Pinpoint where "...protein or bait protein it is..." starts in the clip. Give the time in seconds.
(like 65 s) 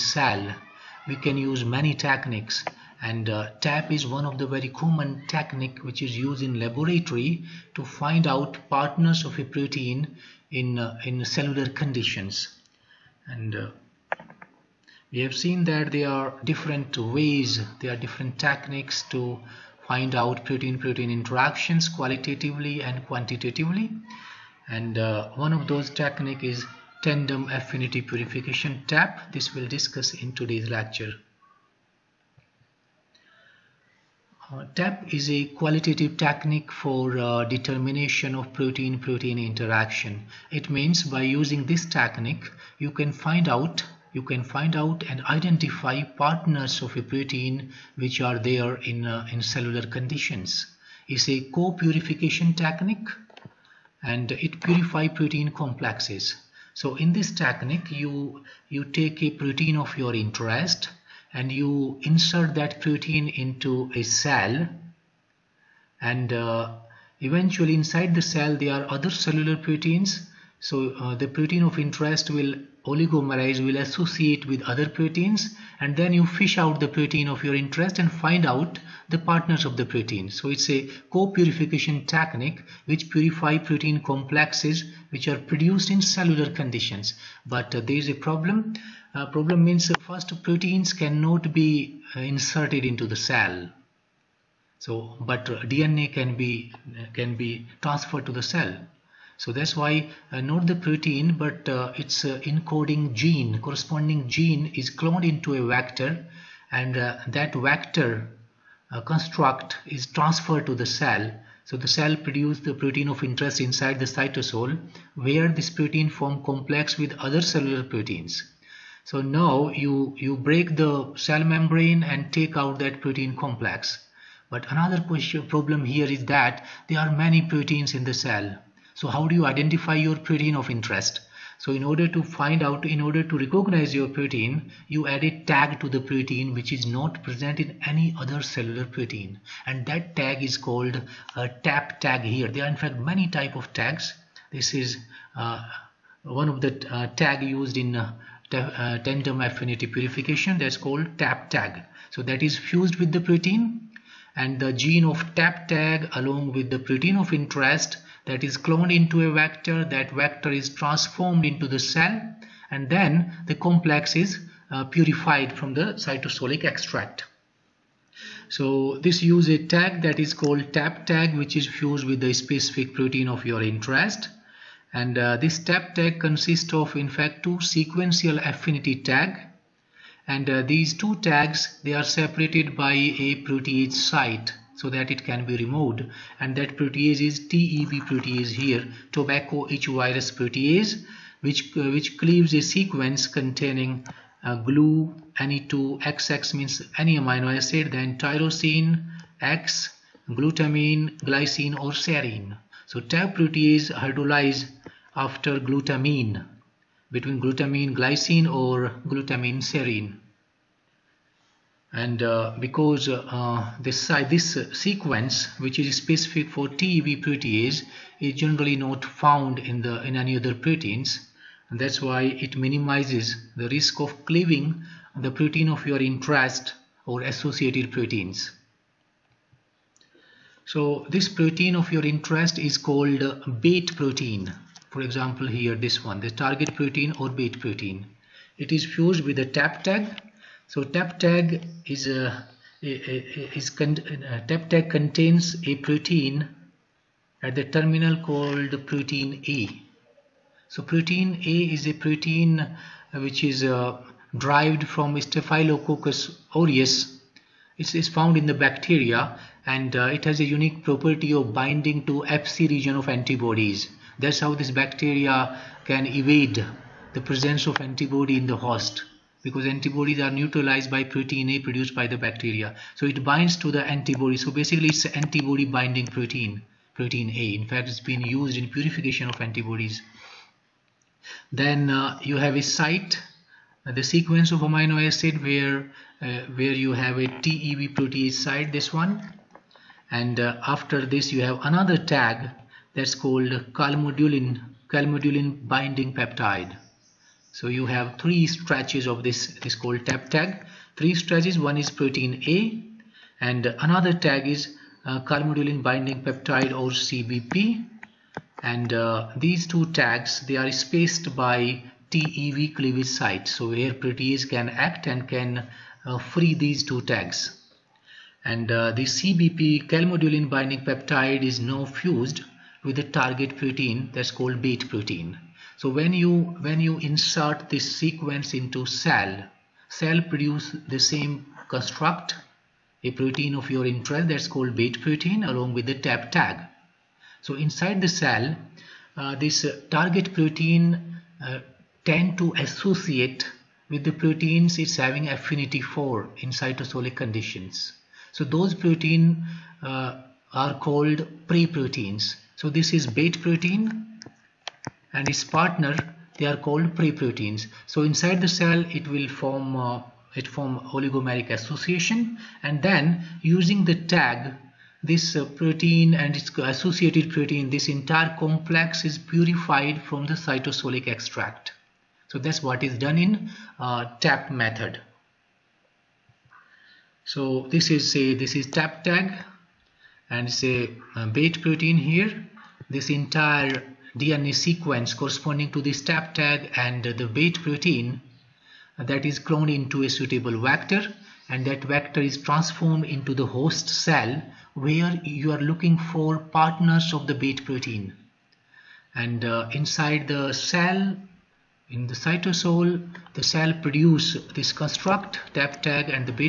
236 s.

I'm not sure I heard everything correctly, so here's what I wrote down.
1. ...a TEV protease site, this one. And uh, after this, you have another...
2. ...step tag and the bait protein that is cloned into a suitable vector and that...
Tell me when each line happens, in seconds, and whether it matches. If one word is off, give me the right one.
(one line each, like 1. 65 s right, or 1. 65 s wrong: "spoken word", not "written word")
1. 287 s right
2. 385 s right.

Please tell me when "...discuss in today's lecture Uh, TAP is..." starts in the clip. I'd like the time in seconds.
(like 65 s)
29 s.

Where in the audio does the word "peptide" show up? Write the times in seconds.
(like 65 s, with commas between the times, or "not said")
296 s, 306 s, 320 s.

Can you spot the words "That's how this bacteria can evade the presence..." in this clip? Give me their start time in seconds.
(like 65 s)
264 s.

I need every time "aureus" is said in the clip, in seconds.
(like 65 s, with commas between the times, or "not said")
256 s.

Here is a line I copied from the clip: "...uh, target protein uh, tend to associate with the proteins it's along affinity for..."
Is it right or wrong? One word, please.
wrong.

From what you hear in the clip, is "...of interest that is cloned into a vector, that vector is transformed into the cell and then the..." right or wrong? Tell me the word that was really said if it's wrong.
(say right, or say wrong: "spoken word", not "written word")
right.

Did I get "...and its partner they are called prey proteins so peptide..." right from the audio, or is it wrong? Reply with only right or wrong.
wrong.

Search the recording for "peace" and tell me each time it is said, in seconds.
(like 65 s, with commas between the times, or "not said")
not said.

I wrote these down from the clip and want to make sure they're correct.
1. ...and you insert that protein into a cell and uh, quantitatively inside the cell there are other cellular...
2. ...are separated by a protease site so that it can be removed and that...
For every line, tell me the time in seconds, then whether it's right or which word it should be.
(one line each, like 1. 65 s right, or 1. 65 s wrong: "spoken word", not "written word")
1. 61 s wrong: "eventually", not "quantitatively"
2. 181 s right.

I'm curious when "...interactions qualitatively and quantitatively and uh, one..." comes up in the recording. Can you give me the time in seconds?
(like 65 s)
21 s.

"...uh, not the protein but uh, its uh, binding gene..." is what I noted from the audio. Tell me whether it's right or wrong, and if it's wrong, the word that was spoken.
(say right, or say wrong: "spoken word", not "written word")
wrong: "encoding", not "binding".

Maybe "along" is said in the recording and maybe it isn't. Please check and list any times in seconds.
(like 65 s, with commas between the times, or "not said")
156 s, 335 s.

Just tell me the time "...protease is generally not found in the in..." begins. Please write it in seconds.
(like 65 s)
217 s.